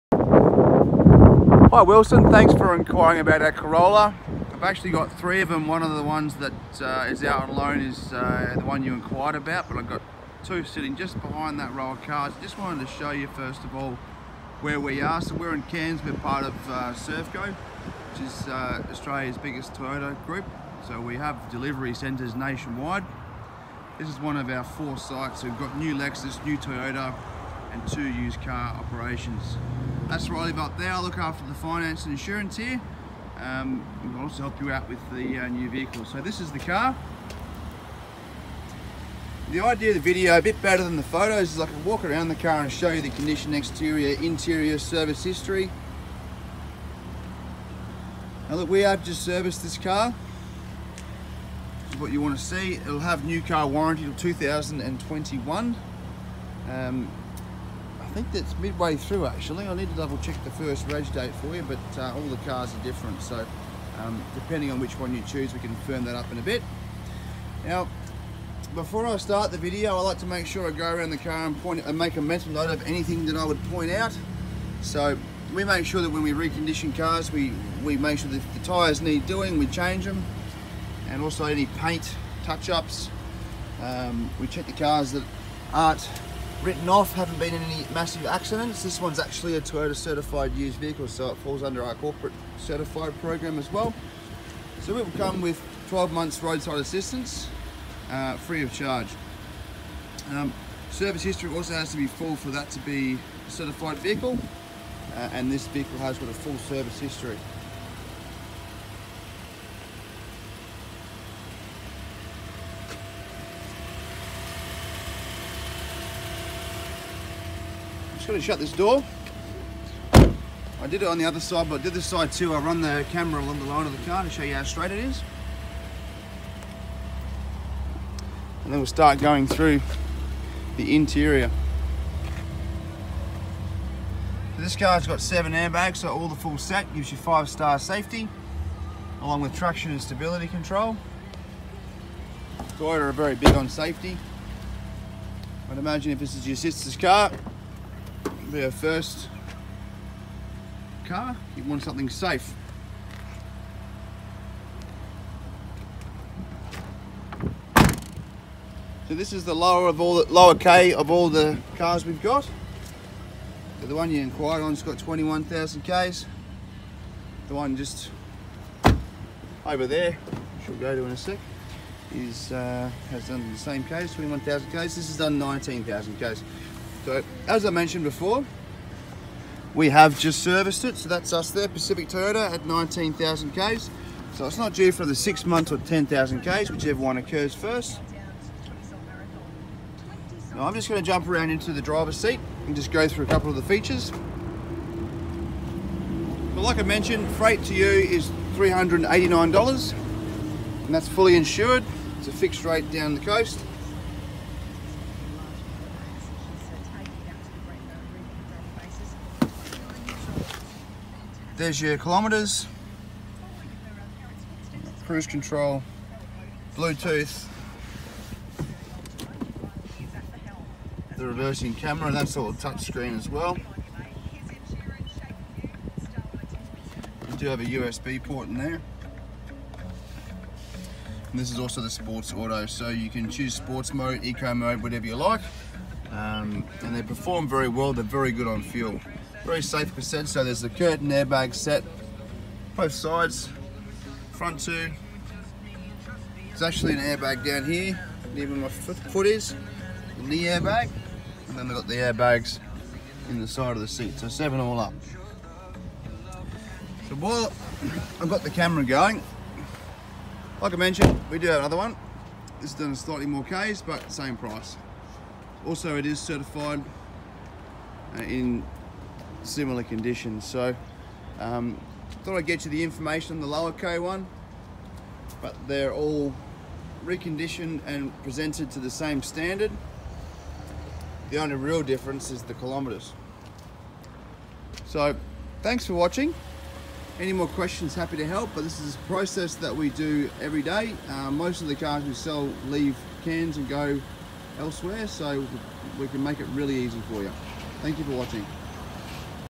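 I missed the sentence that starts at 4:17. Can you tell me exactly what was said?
So while I've got the camera going, like I mentioned, we do have another one.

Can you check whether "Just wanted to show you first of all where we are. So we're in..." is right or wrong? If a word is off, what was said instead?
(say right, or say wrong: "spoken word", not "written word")
right.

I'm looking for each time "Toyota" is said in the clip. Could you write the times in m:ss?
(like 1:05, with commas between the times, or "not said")
0:19, 0:26, 1:29, 2:22, 3:02.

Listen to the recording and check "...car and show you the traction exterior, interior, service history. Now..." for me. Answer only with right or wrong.
wrong.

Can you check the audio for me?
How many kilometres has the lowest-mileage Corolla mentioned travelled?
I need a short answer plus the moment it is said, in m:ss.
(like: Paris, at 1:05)
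19,000 km, at 2:54.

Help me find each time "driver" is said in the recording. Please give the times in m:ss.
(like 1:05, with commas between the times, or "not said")
3:11.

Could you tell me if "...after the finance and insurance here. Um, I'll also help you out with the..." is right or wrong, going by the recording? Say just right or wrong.
right.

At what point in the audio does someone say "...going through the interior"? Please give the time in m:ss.
2:09.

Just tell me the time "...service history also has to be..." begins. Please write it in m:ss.
1:40.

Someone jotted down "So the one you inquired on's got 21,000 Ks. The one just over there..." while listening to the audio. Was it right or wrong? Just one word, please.
right.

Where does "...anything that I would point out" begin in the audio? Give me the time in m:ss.
1:12.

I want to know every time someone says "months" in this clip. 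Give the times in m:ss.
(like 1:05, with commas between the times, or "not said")
1:36, 3:05.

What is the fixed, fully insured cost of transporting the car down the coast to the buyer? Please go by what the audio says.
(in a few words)
$389.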